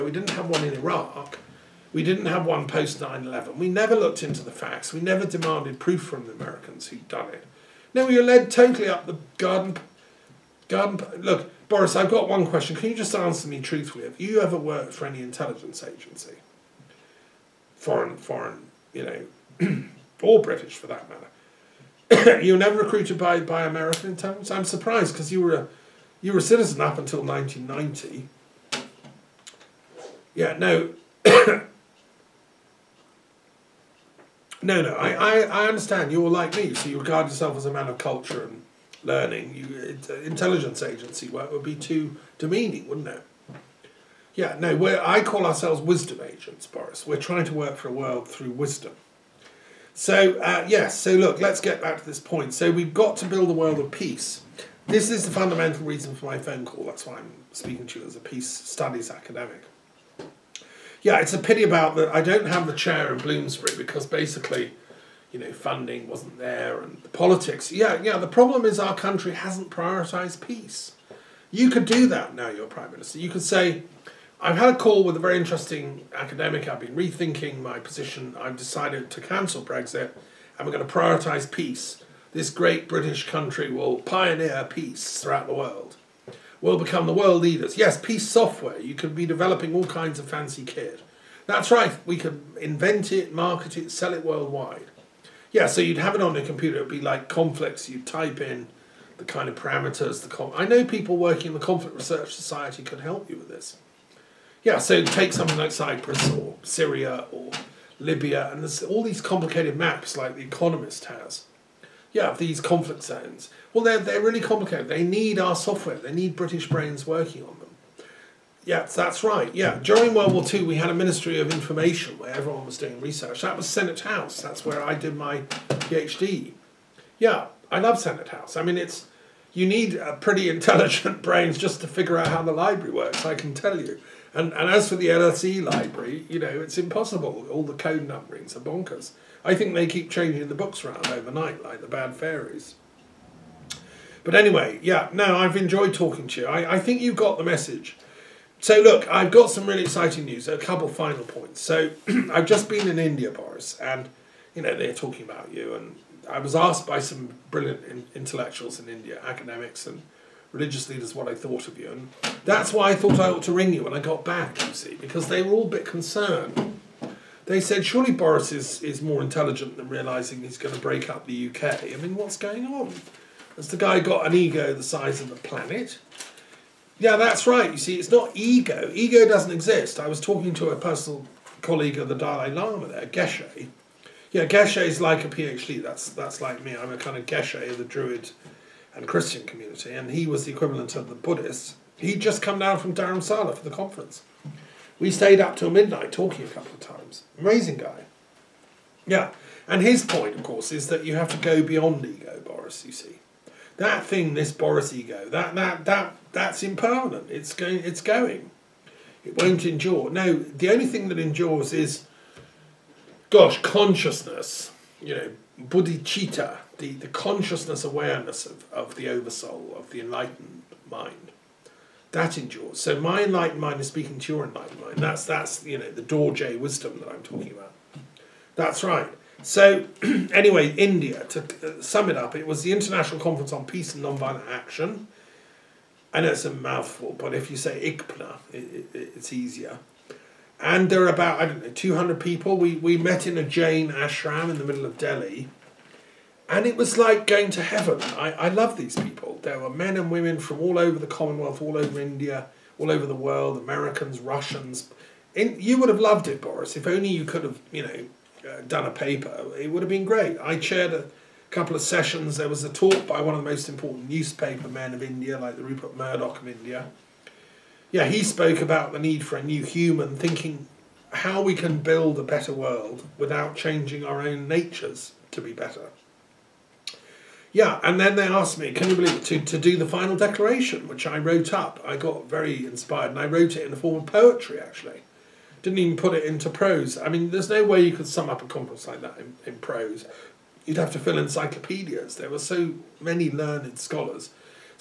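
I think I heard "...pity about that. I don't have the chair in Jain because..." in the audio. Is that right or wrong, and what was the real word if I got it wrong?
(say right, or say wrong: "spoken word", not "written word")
wrong: "Bloomsbury", not "Jain".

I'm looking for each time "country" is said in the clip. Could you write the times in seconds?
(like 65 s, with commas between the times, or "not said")
68 s, 83 s.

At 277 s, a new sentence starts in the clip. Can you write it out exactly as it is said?
Yeah, and then they asked me, can you believe it, to, to do the final declaration, which I wrote up.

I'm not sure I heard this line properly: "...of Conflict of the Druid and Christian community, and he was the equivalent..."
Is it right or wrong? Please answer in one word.
wrong.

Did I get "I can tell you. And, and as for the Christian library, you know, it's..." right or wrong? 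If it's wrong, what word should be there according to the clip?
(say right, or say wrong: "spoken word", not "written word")
wrong: "LSE", not "Christian".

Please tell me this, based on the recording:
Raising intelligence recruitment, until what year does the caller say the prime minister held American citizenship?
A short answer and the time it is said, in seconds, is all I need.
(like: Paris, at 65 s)
1990, at 27 s.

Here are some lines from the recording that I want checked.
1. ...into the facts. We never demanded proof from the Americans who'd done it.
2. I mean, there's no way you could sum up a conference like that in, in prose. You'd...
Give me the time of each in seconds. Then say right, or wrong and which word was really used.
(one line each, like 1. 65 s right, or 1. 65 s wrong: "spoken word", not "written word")
1. 4 s right
2. 286 s right.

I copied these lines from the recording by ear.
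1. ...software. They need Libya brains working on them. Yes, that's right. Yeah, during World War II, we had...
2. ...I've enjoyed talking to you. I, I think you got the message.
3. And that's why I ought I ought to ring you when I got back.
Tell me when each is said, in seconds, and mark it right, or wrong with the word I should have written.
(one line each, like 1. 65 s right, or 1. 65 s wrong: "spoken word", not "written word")
1. 115 s wrong: "British", not "Libya"
2. 145 s right
3. 161 s wrong: "thought", not "ought".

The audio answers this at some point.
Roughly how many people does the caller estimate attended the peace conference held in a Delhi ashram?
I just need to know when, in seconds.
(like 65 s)
241 s.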